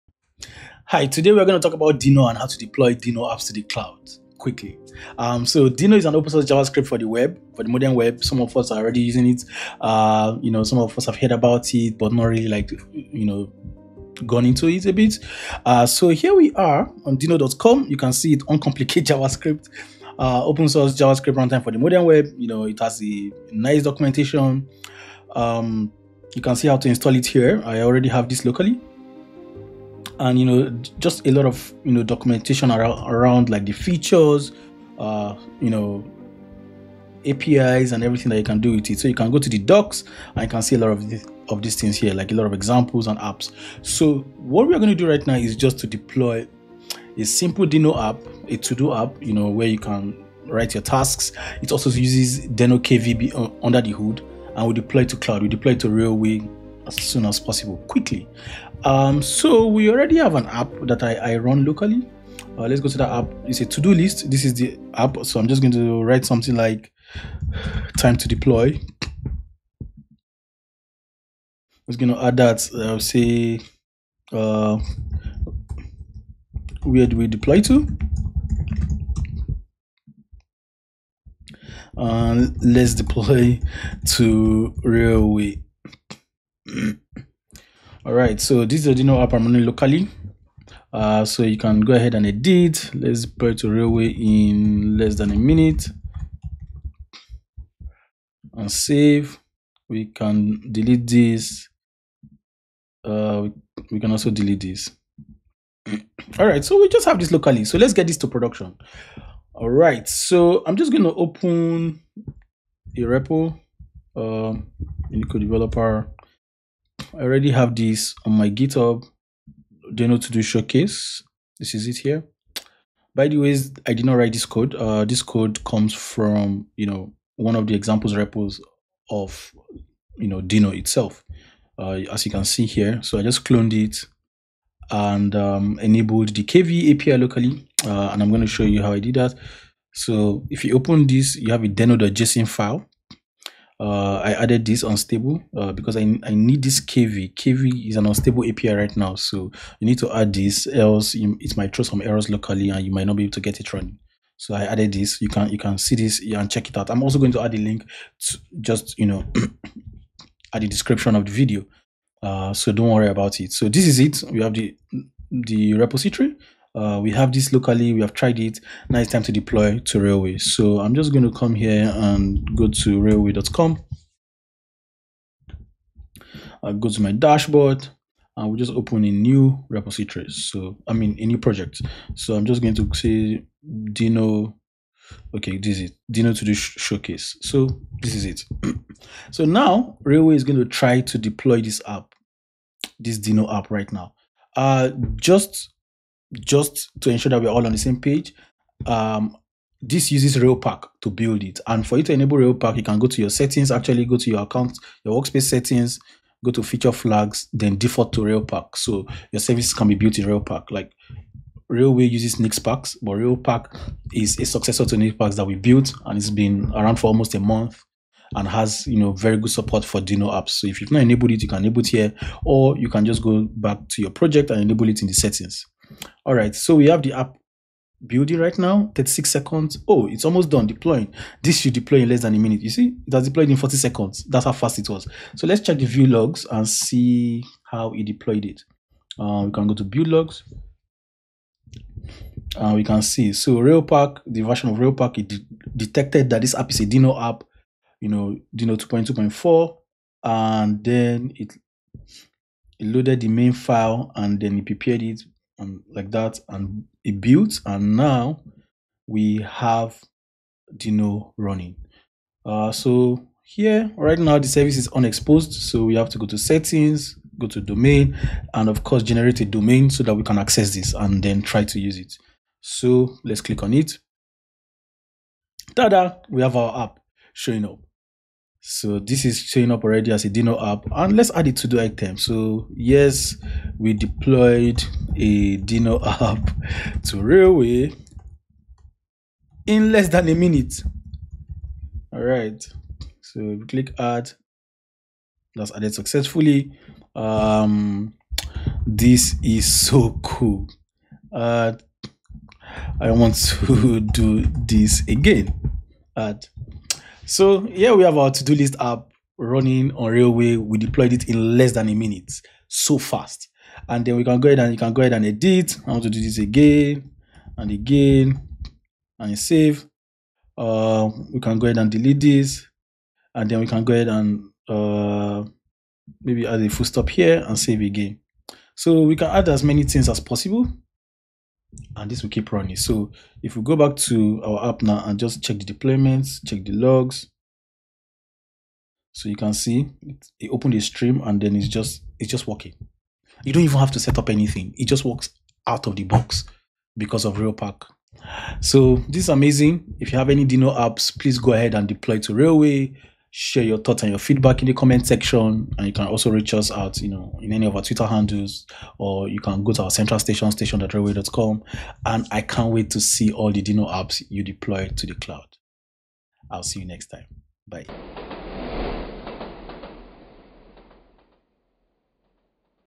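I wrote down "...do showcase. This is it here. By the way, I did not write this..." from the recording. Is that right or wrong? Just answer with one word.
right.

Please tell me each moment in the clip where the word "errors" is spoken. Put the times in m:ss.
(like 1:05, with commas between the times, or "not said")
2:32.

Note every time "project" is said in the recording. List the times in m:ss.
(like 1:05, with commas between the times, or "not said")
3:01, 3:44.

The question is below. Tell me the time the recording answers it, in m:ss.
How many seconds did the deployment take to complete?
3:53.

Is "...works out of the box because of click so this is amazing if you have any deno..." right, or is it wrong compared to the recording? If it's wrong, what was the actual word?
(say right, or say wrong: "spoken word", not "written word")
wrong: "railpack", not "click".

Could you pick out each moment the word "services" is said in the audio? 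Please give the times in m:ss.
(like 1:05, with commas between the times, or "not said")
3:29, 4:24.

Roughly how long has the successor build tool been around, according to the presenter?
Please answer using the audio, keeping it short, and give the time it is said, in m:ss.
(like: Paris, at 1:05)
almost a month, at 3:37.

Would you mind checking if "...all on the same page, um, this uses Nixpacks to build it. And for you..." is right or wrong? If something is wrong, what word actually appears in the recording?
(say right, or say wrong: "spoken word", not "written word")
wrong: "Railpack", not "Nixpacks".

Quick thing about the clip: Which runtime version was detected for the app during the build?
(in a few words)
2.2.4.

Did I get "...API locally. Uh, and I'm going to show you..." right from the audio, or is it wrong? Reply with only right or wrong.
right.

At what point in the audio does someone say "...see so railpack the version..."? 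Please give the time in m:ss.
4:03.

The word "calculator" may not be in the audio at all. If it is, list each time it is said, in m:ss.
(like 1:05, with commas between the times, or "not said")
not said.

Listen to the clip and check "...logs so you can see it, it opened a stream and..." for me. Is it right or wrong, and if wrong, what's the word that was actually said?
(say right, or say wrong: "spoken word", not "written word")
right.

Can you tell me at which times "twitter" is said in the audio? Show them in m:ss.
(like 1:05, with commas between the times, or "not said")
5:57.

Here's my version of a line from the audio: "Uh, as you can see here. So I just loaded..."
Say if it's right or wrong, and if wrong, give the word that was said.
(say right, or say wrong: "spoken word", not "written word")
wrong: "cloned", not "loaded".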